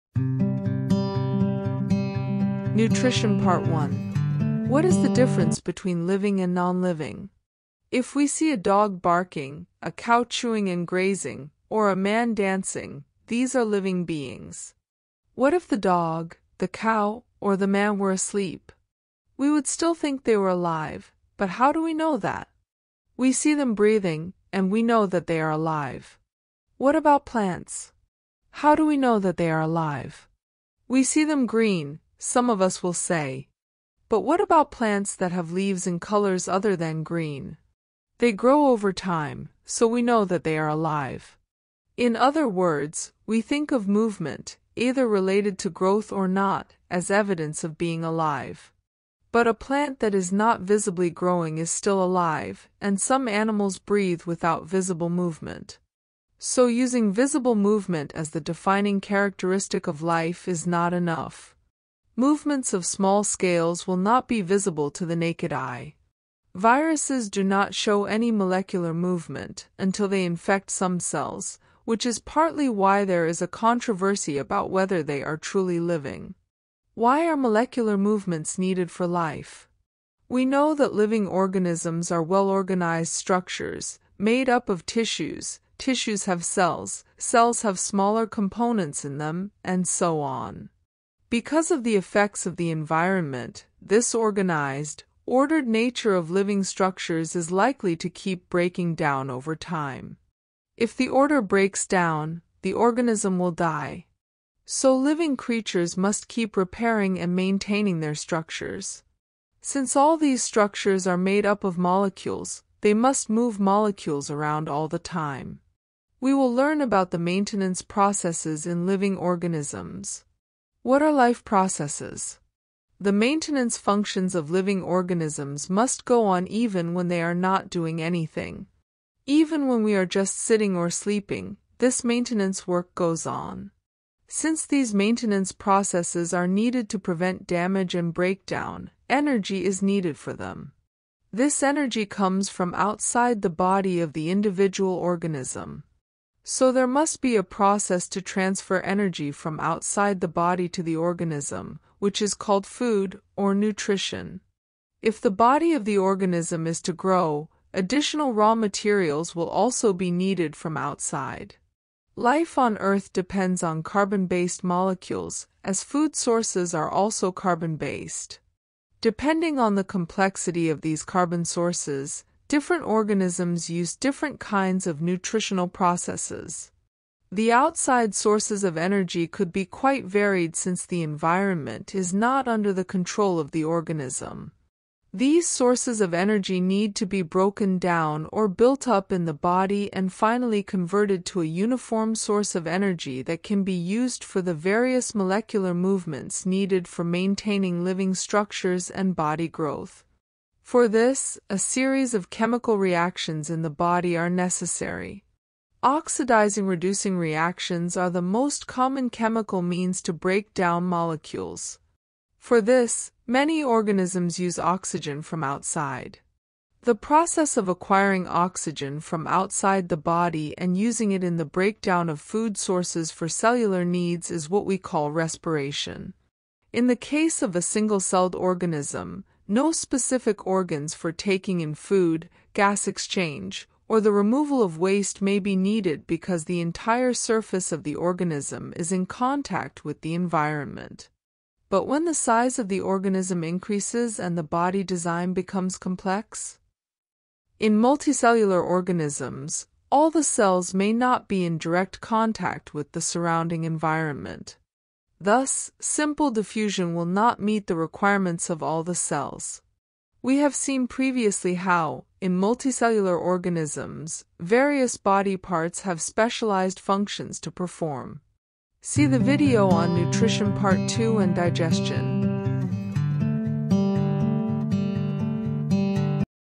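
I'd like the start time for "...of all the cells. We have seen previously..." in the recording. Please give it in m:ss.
4:18.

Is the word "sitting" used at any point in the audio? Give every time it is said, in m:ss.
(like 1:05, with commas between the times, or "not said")
2:10.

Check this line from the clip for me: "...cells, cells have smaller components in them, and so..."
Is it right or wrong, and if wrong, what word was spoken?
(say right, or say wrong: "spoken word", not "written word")
right.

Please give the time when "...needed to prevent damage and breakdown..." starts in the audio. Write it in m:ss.
2:16.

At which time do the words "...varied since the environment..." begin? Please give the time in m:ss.
3:00.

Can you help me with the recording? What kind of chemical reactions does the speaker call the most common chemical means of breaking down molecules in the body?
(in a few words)
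Oxidizing reducing reactions.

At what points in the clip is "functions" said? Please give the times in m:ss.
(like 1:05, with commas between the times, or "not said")
2:03, 4:26.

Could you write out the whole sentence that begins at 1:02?
Movements of small scales will not be visible to the naked eye.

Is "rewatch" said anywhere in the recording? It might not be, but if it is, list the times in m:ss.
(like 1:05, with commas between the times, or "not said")
not said.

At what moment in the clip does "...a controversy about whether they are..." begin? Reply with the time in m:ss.
1:13.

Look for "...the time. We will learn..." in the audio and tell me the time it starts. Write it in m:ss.
1:54.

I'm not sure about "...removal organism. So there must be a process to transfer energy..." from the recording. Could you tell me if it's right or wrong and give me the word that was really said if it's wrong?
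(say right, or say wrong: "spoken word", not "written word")
wrong: "individual", not "removal".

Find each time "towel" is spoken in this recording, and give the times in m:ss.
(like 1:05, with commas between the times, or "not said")
not said.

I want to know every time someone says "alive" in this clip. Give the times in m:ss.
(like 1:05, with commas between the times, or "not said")
0:20, 0:25, 0:29, 0:40, 0:48, 0:52.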